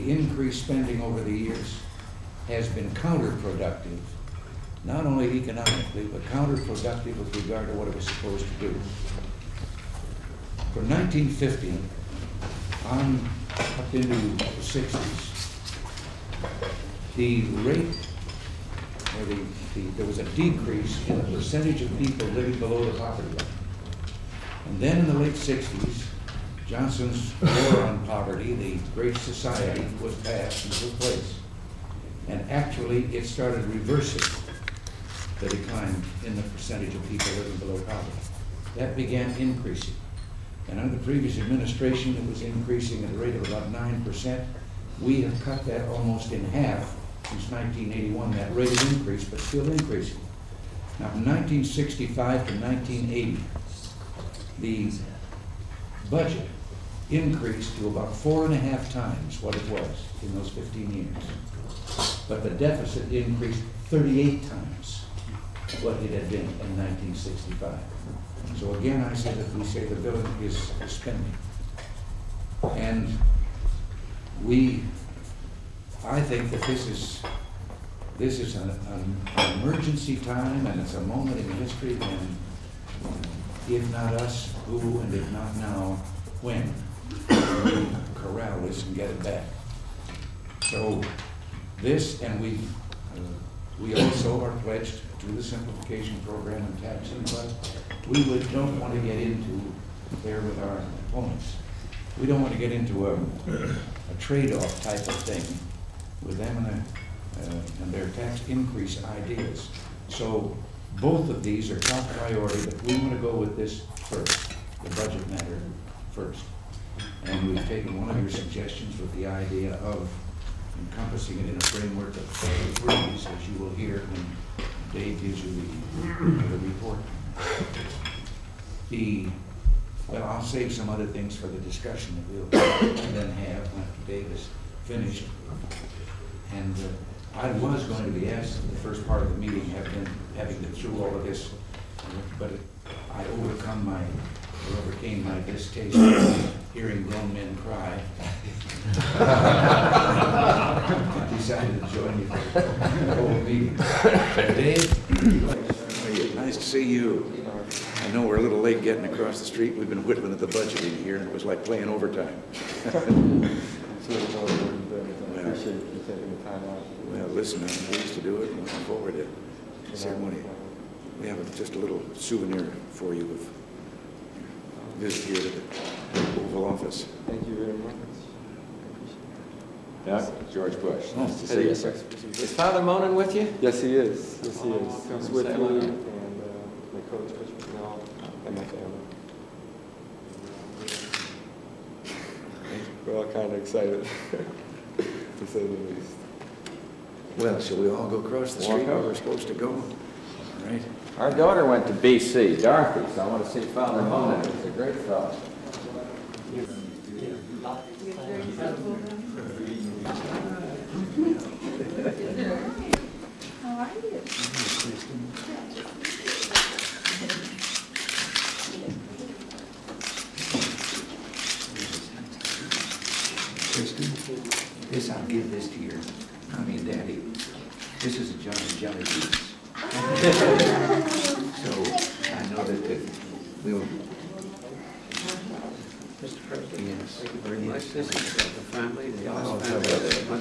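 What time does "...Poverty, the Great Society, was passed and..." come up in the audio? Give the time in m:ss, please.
0:28.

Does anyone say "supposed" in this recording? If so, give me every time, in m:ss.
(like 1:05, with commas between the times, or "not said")
0:08, 3:19.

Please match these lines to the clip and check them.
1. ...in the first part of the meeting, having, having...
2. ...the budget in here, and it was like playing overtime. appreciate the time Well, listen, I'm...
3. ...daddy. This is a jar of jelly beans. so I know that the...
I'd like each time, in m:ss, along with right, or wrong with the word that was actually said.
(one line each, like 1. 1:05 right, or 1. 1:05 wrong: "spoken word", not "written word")
1. 2:18 right
2. 2:40 right
3. 3:46 right.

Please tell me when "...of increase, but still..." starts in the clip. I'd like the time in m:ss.
0:48.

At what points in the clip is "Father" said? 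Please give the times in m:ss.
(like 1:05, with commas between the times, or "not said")
3:02, 3:23.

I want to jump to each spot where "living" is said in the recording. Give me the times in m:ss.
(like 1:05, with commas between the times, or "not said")
0:22, 0:37.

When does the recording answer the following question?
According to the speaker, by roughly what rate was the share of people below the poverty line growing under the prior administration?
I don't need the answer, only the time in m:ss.
0:43.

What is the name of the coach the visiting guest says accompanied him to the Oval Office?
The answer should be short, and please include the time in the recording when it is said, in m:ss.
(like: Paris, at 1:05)
Coach Bicknell, at 3:07.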